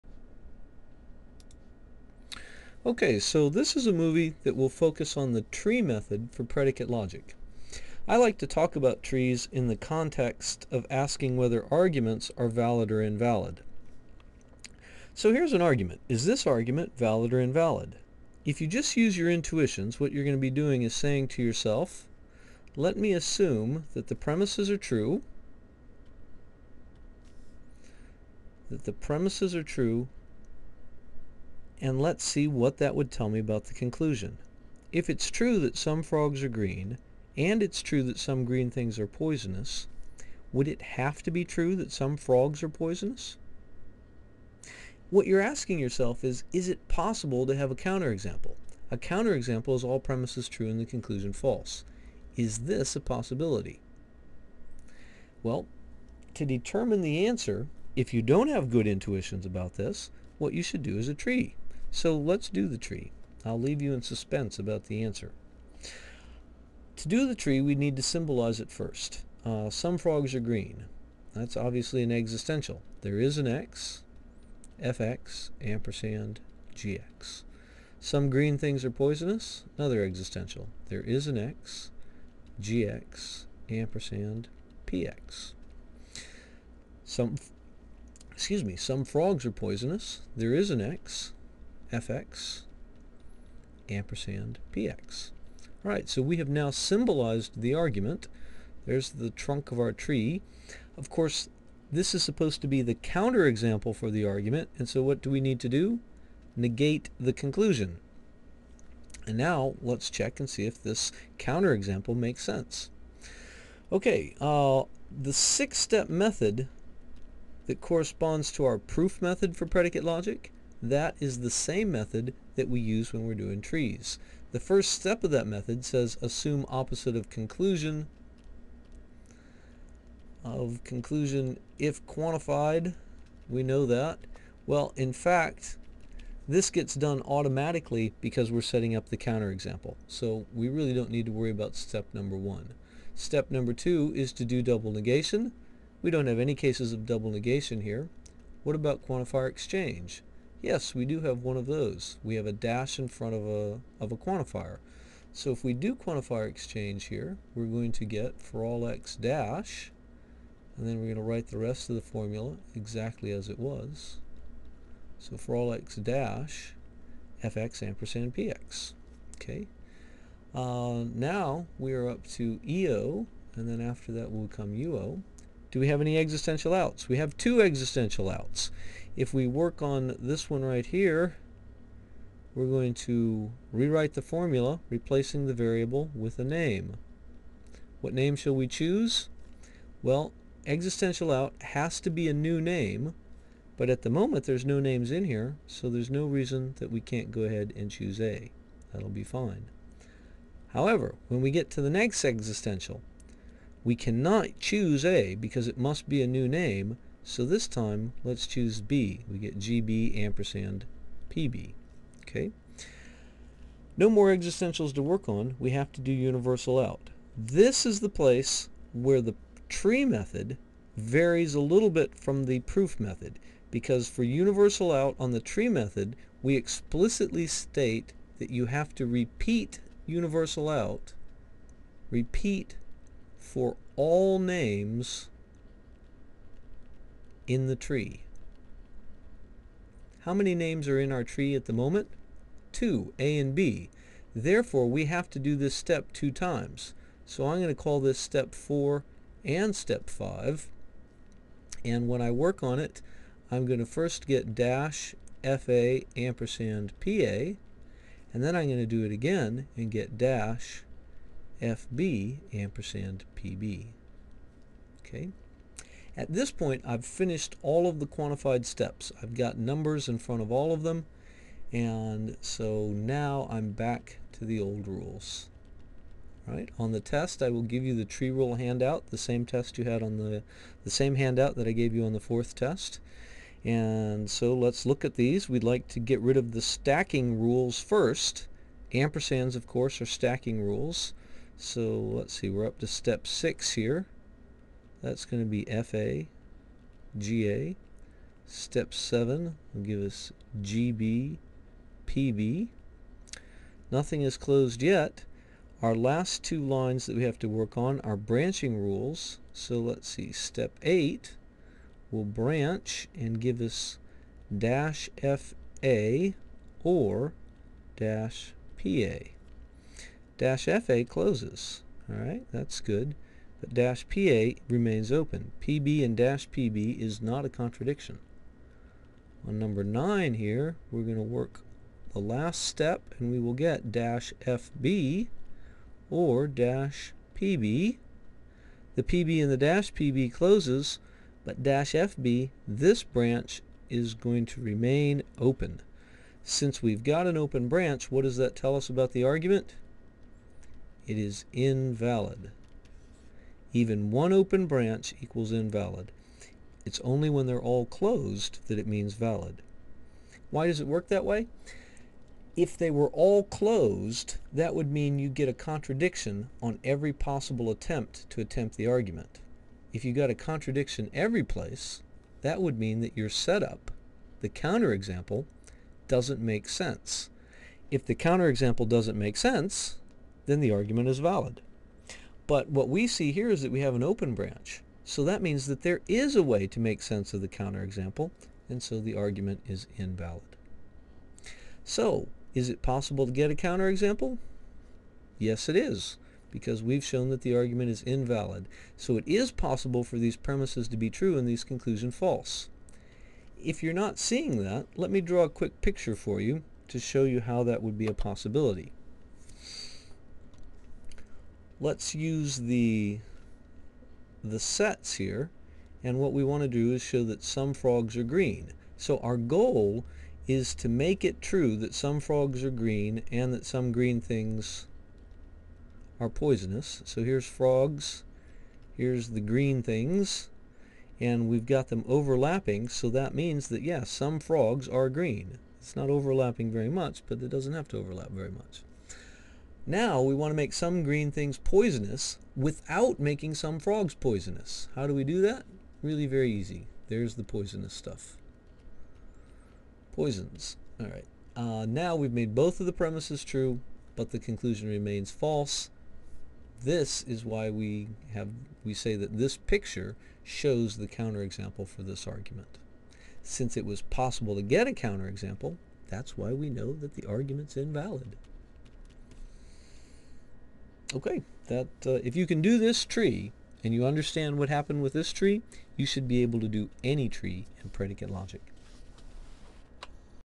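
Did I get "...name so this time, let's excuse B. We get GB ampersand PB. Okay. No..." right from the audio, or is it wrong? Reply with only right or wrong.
wrong.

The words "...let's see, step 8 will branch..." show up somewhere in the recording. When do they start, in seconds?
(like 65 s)
309 s.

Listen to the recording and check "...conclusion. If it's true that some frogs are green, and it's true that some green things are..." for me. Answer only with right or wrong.
right.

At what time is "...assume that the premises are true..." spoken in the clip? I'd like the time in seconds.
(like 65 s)
23 s.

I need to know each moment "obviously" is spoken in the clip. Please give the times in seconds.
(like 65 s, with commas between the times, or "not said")
71 s.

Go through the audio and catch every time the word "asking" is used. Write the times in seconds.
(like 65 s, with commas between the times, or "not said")
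10 s, 45 s.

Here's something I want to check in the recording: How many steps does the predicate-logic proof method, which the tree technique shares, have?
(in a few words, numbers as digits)
6.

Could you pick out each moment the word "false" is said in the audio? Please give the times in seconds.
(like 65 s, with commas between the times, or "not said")
51 s, 402 s, 455 s.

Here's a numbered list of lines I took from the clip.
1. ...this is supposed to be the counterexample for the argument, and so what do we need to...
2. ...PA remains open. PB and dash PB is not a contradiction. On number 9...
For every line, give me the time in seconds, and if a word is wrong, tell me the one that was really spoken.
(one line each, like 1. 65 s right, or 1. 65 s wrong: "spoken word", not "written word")
1. 101 s right
2. 324 s right.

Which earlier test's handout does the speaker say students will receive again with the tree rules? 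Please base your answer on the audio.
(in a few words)
the fourth test.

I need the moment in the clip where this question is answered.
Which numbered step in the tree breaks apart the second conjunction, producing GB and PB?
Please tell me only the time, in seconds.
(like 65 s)
298 s.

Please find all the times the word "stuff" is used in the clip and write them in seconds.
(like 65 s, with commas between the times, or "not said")
447 s.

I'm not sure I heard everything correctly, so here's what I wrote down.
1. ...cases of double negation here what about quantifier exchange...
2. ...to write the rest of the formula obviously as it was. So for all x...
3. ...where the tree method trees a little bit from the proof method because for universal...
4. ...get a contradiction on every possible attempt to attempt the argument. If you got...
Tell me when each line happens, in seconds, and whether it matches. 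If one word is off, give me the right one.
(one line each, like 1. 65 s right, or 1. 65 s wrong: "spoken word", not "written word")
1. 146 s right
2. 161 s wrong: "exactly", not "obviously"
3. 218 s wrong: "varies", not "trees"
4. 365 s right.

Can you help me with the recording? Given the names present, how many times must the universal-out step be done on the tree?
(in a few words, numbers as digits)
2.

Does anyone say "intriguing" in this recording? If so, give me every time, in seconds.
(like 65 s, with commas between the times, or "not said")
not said.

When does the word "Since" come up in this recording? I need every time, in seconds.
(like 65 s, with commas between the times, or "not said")
346 s, 463 s.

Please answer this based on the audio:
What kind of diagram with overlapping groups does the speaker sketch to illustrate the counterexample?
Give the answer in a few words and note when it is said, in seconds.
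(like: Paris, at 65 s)
sets, at 414 s.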